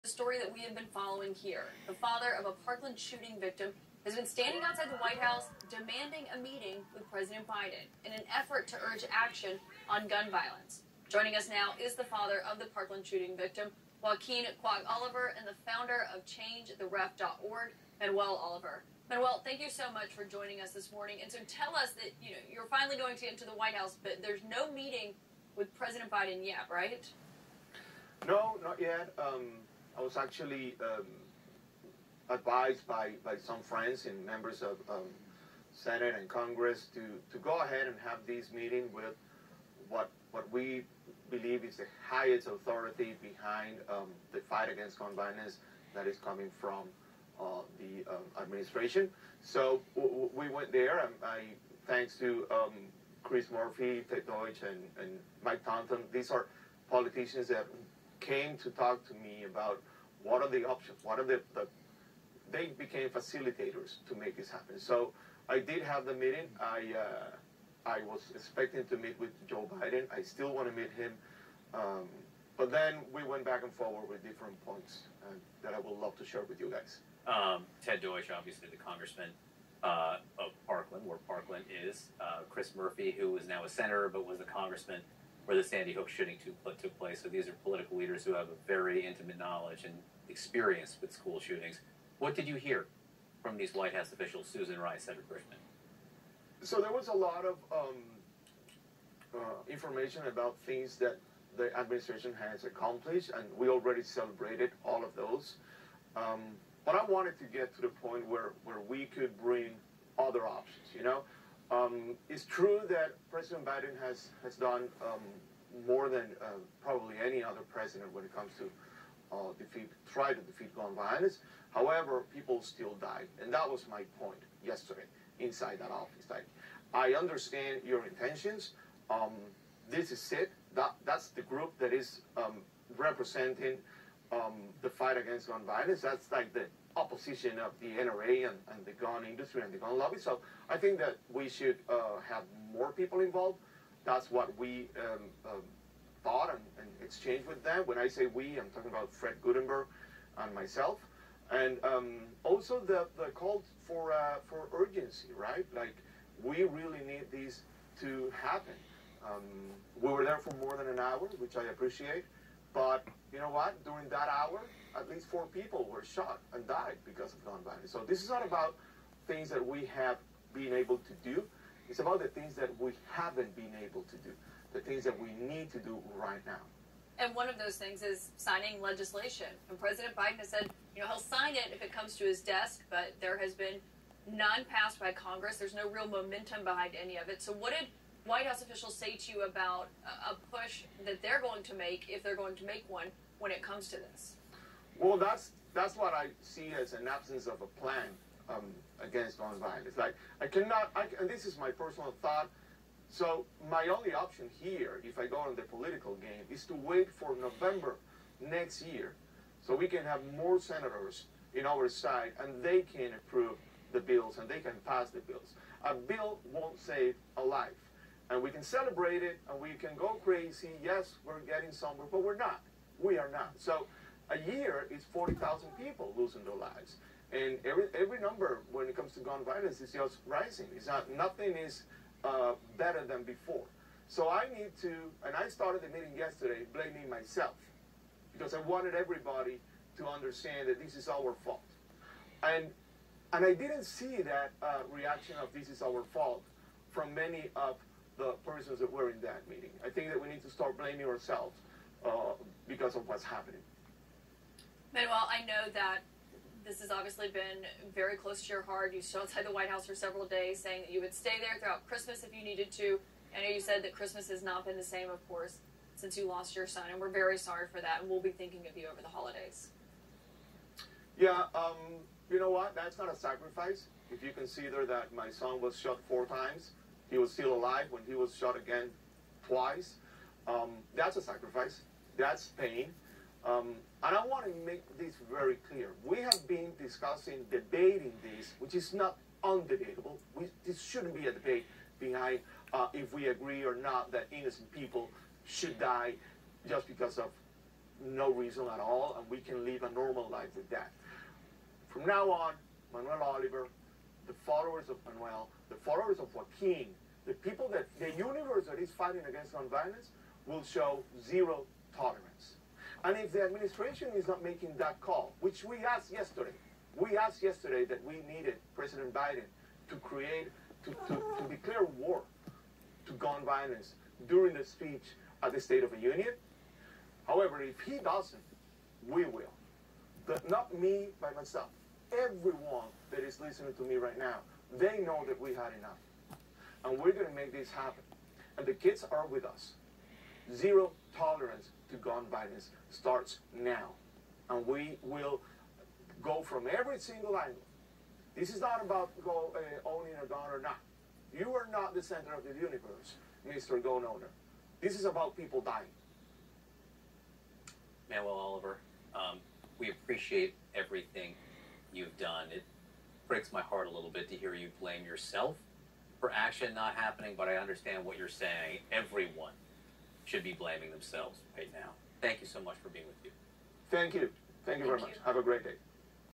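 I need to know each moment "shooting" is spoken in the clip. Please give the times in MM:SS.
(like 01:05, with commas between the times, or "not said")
00:02, 00:13, 01:26, 01:31.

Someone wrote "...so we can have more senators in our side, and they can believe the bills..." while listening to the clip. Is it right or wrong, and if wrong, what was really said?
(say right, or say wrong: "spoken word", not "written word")
wrong: "approve", not "believe".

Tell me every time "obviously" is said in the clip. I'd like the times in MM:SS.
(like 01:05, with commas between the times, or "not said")
01:18, 04:16.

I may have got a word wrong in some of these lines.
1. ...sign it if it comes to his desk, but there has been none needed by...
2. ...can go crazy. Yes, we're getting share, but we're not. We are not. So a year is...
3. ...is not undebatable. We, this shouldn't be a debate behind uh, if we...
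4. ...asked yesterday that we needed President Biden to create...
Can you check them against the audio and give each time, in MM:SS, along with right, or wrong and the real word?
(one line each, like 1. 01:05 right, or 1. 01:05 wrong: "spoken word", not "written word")
1. 03:01 wrong: "passed", not "needed"
2. 03:39 wrong: "somewhere", not "share"
3. 04:48 right
4. 05:17 right.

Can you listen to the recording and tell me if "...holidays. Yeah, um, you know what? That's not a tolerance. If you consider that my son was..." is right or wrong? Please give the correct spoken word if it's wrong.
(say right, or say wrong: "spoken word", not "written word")
wrong: "sacrifice", not "tolerance".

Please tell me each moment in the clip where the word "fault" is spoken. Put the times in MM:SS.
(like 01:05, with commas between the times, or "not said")
04:01, 04:06.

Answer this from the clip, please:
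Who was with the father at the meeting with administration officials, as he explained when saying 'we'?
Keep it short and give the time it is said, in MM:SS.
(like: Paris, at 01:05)
Fred Guttenberg, at 02:29.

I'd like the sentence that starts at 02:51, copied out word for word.
It's about the things that we haven't been able to do, the things that we need to do right now.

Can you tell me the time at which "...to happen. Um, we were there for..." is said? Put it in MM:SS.
02:37.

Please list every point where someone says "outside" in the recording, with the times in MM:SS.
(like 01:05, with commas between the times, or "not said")
00:04, 04:19.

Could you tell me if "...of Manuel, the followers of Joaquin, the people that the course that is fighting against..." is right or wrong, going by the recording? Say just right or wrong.
wrong.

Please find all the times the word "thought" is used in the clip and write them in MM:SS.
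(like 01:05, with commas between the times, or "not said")
02:26, 03:22.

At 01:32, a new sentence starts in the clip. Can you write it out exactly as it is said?
What did you hear from these White House officials, Susan Rice, Cedric Griffin?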